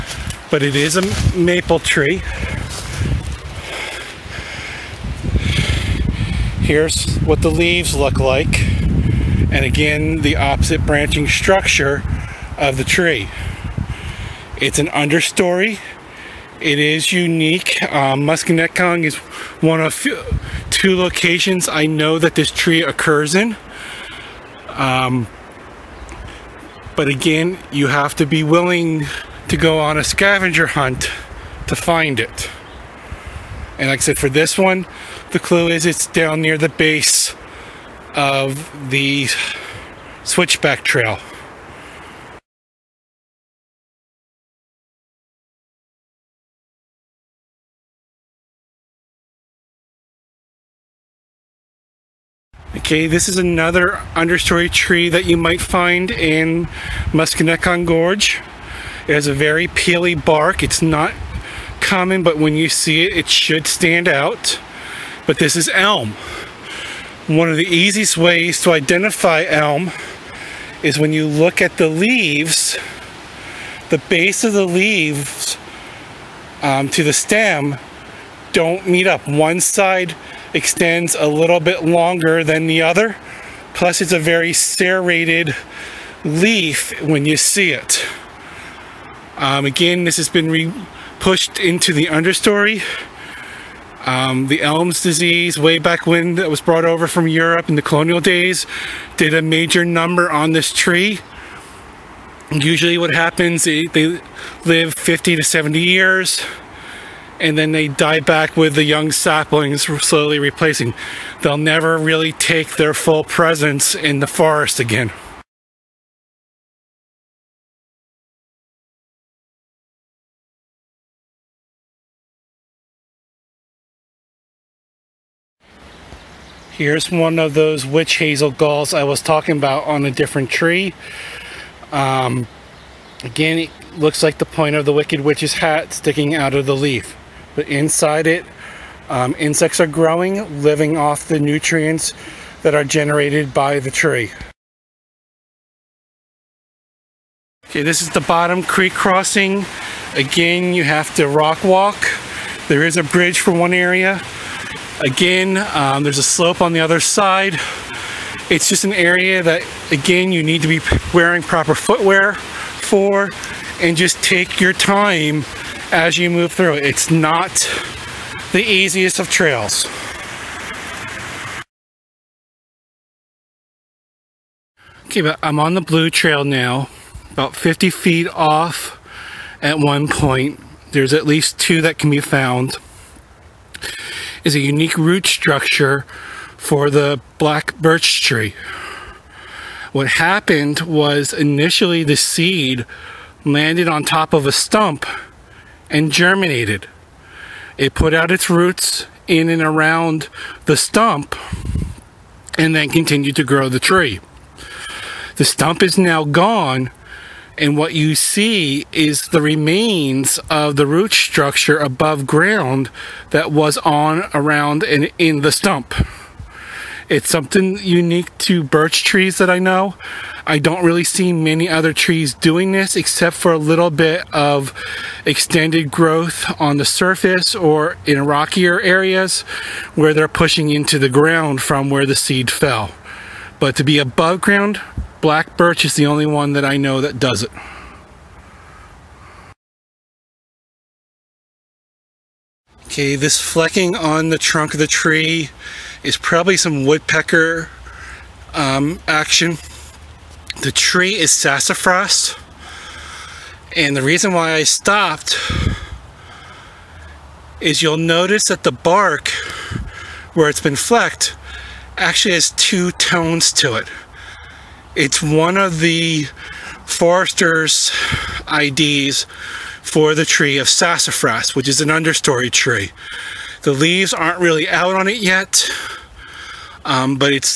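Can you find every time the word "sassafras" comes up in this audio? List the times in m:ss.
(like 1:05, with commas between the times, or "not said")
4:11, 4:30.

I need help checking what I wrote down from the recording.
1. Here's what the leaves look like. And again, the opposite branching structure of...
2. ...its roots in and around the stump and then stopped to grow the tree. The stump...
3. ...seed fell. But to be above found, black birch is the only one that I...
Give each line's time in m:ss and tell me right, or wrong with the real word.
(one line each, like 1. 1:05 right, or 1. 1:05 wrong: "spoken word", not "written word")
1. 0:06 right
2. 3:18 wrong: "continued", not "stopped"
3. 3:52 wrong: "ground", not "found".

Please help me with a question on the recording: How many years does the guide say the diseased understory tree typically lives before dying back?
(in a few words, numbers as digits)
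50 to 70 years.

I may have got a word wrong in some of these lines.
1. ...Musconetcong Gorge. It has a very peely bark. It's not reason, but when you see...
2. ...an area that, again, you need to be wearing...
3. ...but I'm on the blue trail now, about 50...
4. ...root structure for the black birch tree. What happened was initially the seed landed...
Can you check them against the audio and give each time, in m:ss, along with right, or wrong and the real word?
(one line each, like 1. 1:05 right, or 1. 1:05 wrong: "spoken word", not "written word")
1. 0:57 wrong: "common", not "reason"
2. 2:38 right
3. 2:55 right
4. 3:04 right.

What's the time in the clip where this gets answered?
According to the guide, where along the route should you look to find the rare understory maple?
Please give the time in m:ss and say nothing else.
0:36.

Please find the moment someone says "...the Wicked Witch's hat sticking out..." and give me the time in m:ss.
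2:14.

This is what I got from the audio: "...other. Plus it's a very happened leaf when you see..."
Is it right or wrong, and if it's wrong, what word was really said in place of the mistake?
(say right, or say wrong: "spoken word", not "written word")
wrong: "serrated", not "happened".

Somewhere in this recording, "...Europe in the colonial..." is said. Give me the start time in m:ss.
1:37.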